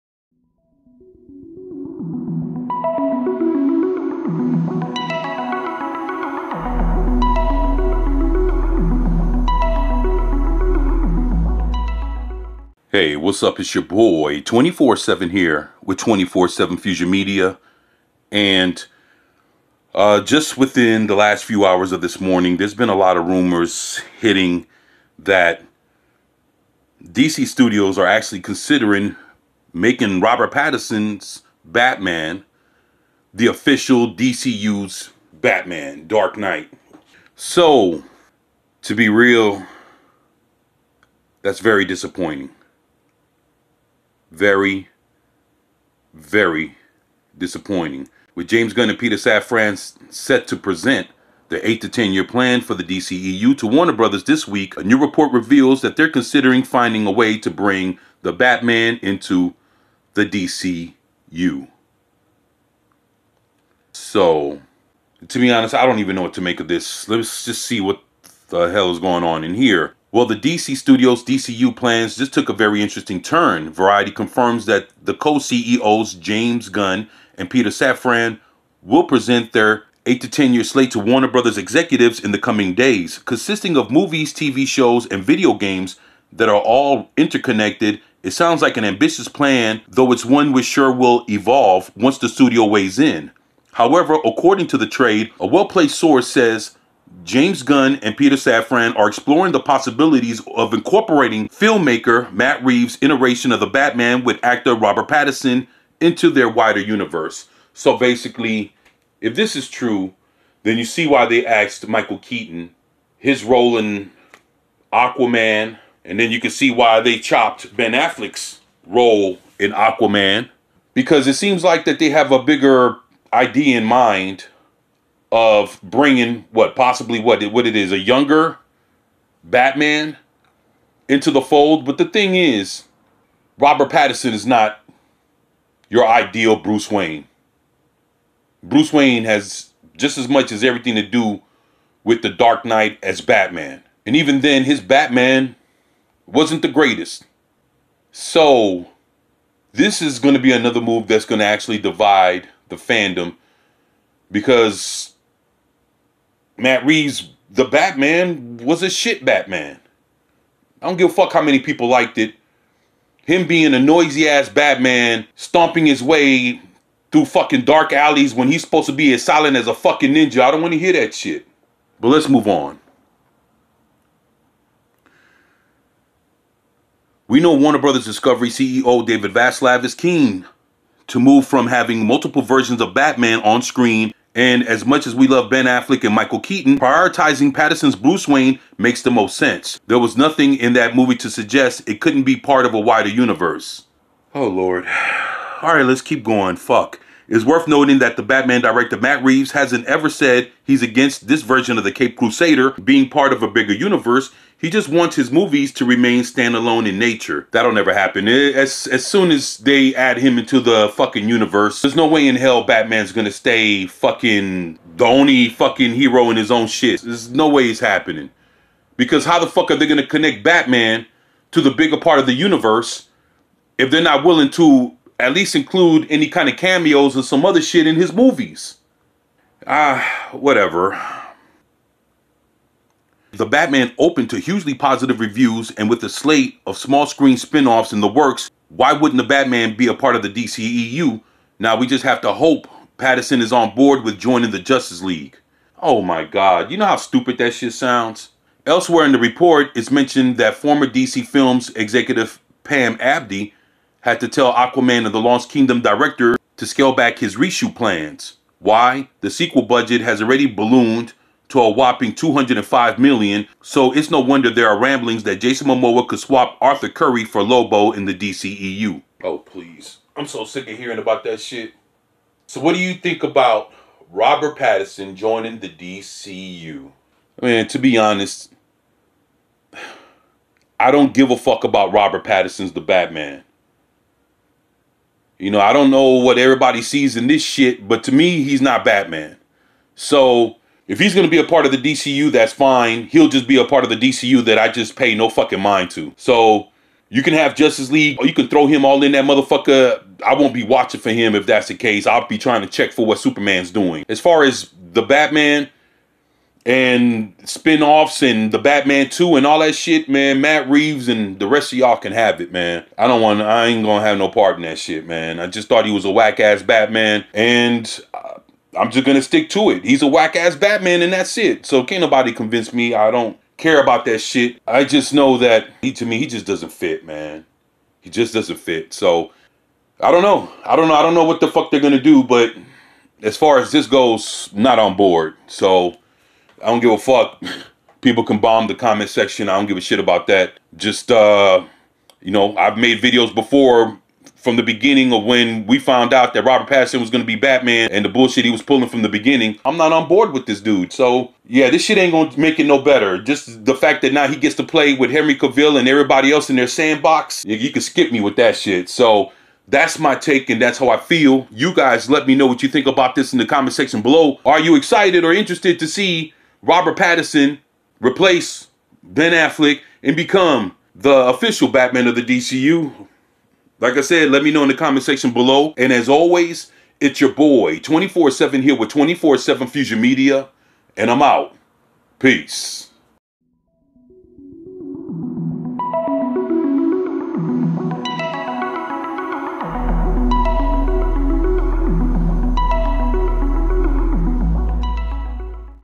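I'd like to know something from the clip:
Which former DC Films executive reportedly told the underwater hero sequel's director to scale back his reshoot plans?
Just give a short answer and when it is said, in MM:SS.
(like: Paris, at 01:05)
Pam Abdy, at 04:12.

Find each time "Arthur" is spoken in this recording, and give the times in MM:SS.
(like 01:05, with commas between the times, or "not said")
04:26.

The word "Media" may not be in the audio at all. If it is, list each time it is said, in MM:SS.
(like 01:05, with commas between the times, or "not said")
00:17, 06:20.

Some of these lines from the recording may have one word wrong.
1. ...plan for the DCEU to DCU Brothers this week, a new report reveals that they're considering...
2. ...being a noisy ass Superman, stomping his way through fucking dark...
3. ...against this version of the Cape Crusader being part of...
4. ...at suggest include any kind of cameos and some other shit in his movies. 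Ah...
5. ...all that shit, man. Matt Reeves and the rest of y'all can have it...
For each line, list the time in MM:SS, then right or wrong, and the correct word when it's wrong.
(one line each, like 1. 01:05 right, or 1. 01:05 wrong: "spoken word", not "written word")
1. 00:52 wrong: "Warner", not "DCU"
2. 02:43 wrong: "Batman", not "Superman"
3. 03:20 right
4. 03:45 wrong: "least", not "suggest"
5. 05:09 right.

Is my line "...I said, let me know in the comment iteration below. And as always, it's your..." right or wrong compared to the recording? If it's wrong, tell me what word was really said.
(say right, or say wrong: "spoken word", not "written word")
wrong: "section", not "iteration".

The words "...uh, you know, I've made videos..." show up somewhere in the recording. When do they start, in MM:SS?
05:41.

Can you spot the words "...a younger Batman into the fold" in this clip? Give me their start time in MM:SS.
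02:07.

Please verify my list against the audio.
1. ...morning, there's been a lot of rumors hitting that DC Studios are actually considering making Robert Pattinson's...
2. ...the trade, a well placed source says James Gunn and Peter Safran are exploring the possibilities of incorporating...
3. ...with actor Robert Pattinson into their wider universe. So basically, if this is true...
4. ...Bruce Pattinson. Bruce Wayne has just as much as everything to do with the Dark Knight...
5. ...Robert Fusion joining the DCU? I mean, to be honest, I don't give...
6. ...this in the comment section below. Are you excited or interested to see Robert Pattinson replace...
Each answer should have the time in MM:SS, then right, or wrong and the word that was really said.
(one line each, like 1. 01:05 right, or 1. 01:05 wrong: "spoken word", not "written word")
1. 00:22 right
2. 01:34 right
3. 01:44 right
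4. 02:16 wrong: "Wayne", not "Pattinson"
5. 04:34 wrong: "Pattinson", not "Fusion"
6. 06:03 right.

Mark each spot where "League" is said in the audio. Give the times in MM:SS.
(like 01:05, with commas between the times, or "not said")
04:05, 04:57.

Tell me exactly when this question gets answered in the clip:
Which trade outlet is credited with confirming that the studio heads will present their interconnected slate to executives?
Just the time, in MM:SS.
01:13.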